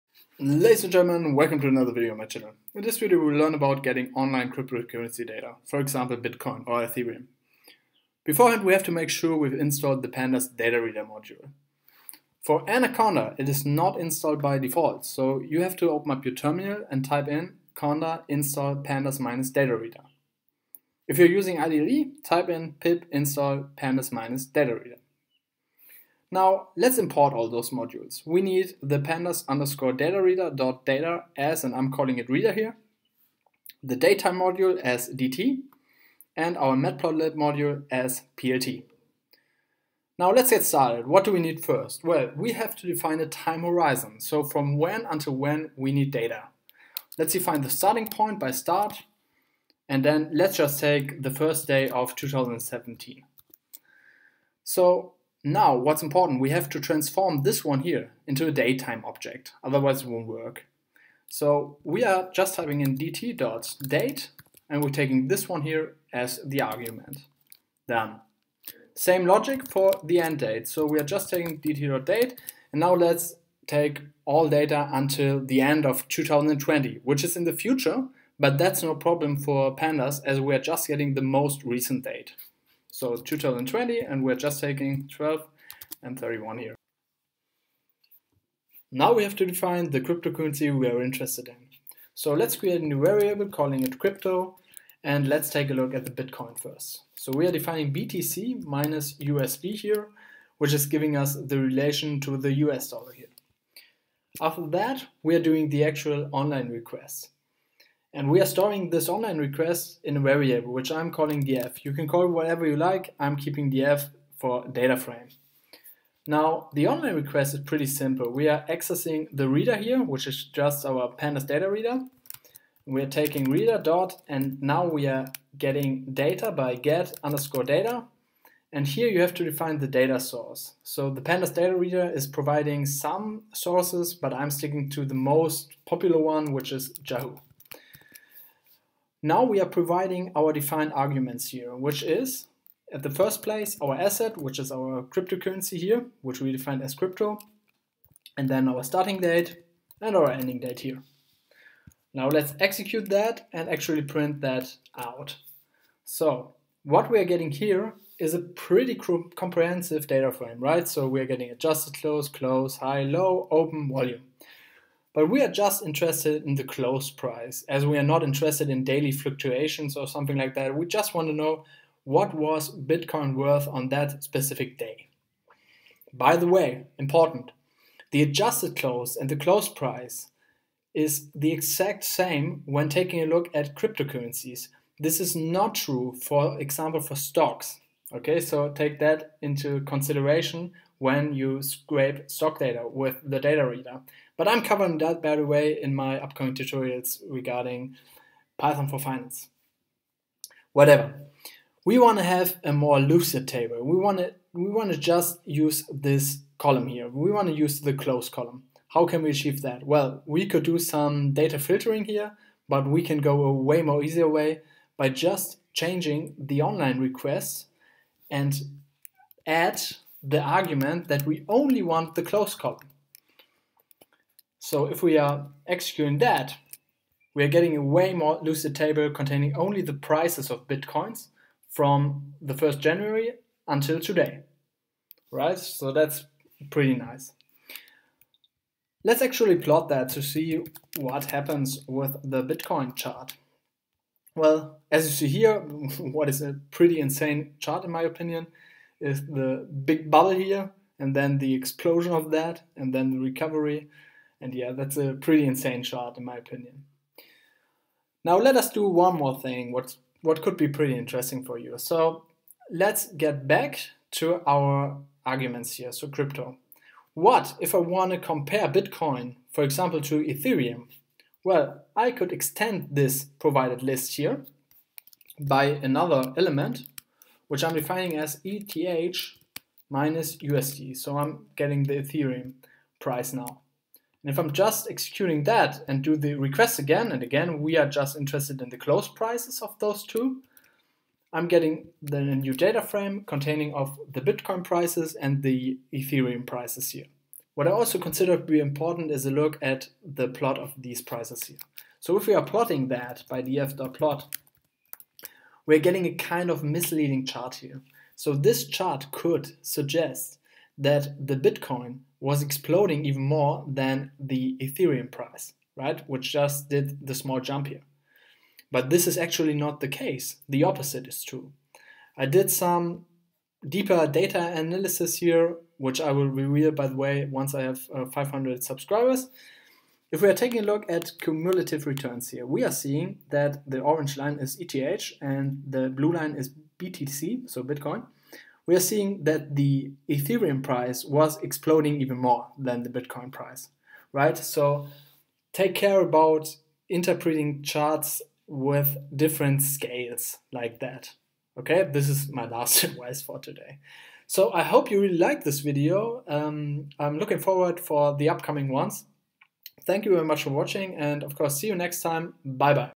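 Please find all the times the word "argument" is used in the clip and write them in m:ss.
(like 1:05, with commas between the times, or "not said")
1:06, 2:20, 3:40, 4:25.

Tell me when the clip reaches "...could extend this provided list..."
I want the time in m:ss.
4:32.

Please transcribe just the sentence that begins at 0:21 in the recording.
If you're using IDE, type in pip install pandas minus data reader.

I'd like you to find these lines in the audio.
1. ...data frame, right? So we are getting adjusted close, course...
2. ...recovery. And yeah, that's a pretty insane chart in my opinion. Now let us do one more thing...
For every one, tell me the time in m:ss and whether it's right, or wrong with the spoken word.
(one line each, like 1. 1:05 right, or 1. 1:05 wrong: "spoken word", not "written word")
1. 2:40 wrong: "close", not "course"
2. 4:13 right.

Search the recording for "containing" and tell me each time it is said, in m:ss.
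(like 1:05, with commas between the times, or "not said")
3:49, 4:53.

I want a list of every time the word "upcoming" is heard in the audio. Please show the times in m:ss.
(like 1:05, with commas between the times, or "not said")
3:16, 5:58.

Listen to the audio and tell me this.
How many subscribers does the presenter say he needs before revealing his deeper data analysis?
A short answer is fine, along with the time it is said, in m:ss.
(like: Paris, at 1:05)
500, at 5:28.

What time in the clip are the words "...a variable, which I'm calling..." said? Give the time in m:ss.
1:50.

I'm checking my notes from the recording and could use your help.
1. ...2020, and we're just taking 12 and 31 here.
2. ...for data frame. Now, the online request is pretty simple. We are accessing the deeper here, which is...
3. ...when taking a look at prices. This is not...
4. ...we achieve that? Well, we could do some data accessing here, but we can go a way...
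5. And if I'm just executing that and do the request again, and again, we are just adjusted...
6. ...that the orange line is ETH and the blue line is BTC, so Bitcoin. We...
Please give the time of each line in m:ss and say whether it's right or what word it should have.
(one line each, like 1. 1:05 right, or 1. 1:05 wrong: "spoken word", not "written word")
1. 1:23 right
2. 1:54 wrong: "reader", not "deeper"
3. 3:02 wrong: "cryptocurrencies", not "prices"
4. 3:29 wrong: "filtering", not "accessing"
5. 4:44 wrong: "interested", not "adjusted"
6. 5:33 right.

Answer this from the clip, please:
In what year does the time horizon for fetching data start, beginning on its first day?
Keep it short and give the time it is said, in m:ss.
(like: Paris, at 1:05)
2017, at 0:52.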